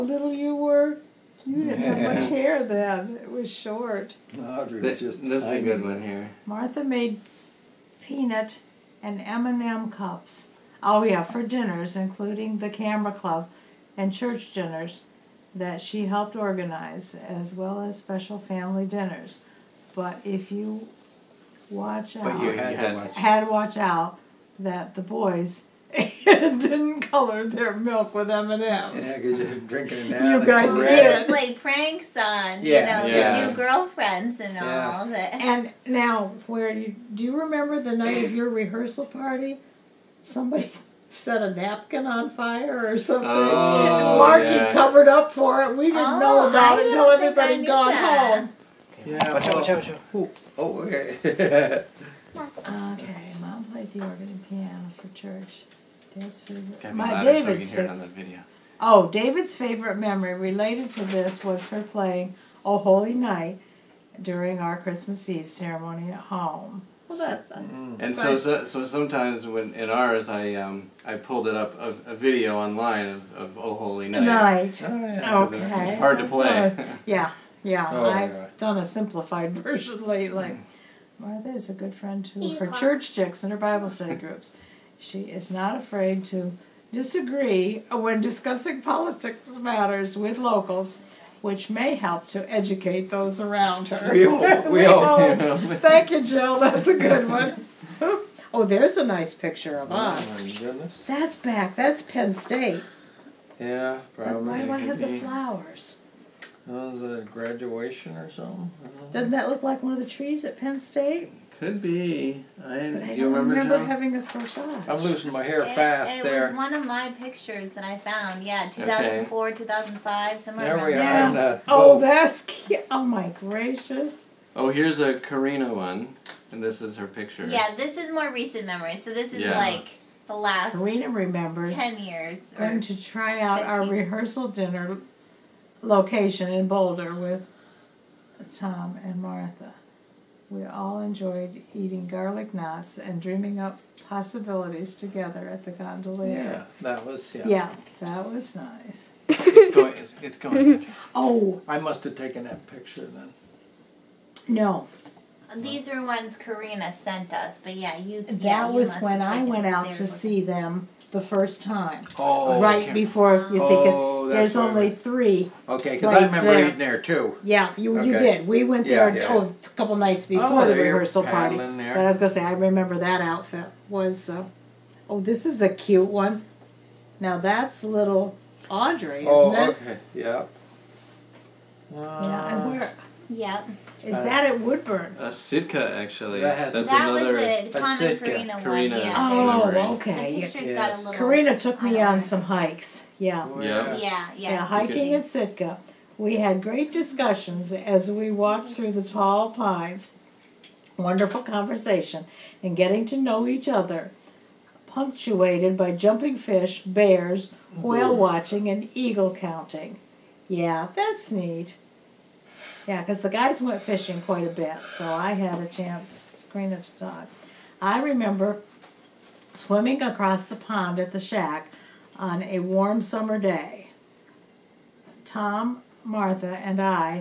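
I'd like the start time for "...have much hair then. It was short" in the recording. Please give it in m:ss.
0:01.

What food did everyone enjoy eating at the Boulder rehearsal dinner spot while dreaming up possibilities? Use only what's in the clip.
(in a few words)
Garlic knots.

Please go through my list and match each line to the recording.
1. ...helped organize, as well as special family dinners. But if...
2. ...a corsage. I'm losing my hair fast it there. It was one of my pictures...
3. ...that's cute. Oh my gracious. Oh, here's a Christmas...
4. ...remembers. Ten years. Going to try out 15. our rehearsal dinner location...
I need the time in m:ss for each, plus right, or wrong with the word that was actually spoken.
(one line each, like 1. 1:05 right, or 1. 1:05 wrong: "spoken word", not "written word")
1. 0:16 right
2. 1:54 right
3. 2:01 wrong: "Karina", not "Christmas"
4. 2:11 right.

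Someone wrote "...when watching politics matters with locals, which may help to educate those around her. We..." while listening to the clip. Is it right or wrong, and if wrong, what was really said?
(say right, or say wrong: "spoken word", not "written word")
wrong: "discussing", not "watching".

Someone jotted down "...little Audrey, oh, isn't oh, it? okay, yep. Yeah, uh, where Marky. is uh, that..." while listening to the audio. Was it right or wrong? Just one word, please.
wrong.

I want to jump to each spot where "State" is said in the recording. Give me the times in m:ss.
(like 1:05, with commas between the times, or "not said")
1:42, 1:50.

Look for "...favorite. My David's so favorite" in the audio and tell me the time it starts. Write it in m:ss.
0:56.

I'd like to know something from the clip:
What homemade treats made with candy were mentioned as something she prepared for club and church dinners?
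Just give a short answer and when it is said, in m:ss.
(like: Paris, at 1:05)
Peanut and M&M cups, at 0:08.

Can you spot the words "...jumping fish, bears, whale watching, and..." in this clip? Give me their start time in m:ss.
3:25.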